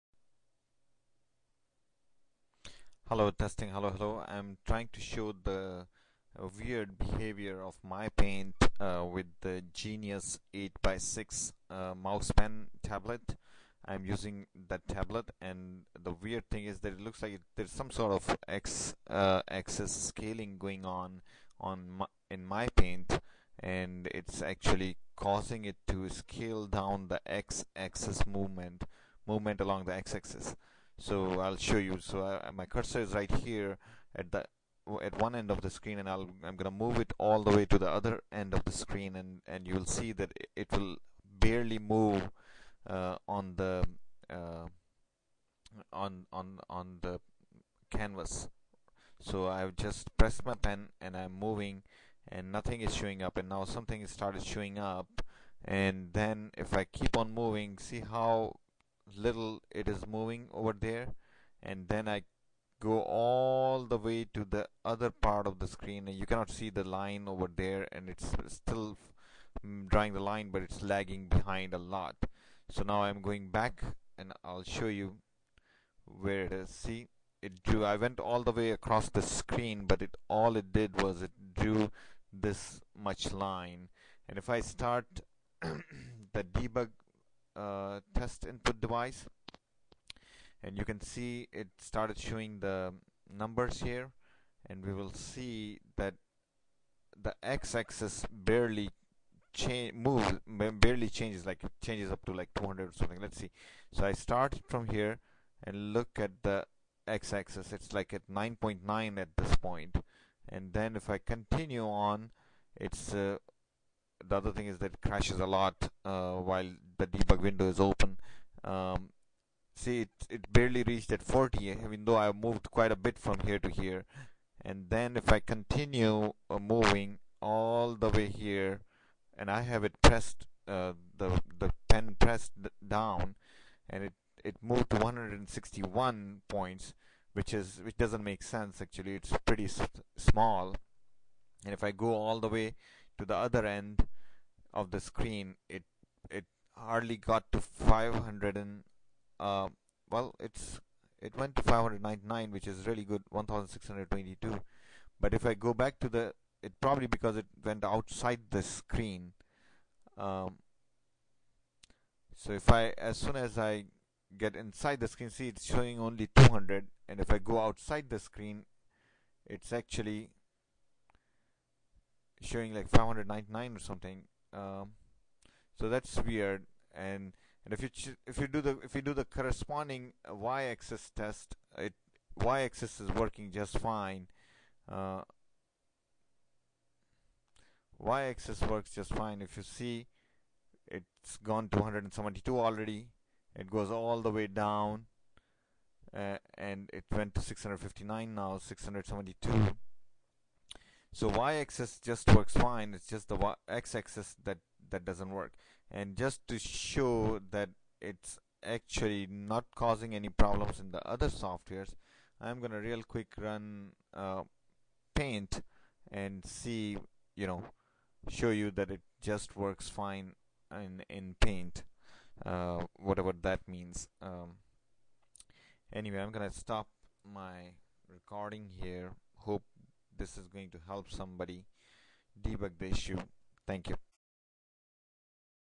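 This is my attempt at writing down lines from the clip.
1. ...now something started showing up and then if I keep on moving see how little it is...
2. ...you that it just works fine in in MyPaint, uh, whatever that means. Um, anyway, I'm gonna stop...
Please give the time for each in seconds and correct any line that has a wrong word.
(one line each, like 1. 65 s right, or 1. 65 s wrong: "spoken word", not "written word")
1. 53 s right
2. 218 s wrong: "Paint", not "MyPaint".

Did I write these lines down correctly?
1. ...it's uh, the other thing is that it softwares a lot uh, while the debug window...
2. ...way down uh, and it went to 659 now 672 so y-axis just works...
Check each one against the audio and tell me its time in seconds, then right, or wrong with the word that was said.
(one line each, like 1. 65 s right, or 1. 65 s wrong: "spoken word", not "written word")
1. 112 s wrong: "crashes", not "softwares"
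2. 194 s right.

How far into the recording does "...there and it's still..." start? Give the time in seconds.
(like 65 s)
67 s.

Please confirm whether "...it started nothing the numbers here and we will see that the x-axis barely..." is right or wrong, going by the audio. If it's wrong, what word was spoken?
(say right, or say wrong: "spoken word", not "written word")
wrong: "showing", not "nothing".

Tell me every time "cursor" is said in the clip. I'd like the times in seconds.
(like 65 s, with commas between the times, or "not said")
32 s.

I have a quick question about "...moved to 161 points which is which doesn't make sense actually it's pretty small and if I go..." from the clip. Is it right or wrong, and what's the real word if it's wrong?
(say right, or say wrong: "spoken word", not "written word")
right.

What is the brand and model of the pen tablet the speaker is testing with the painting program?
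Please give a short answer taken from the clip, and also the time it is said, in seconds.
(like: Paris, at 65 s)
Genius 8x6 MousePen, at 9 s.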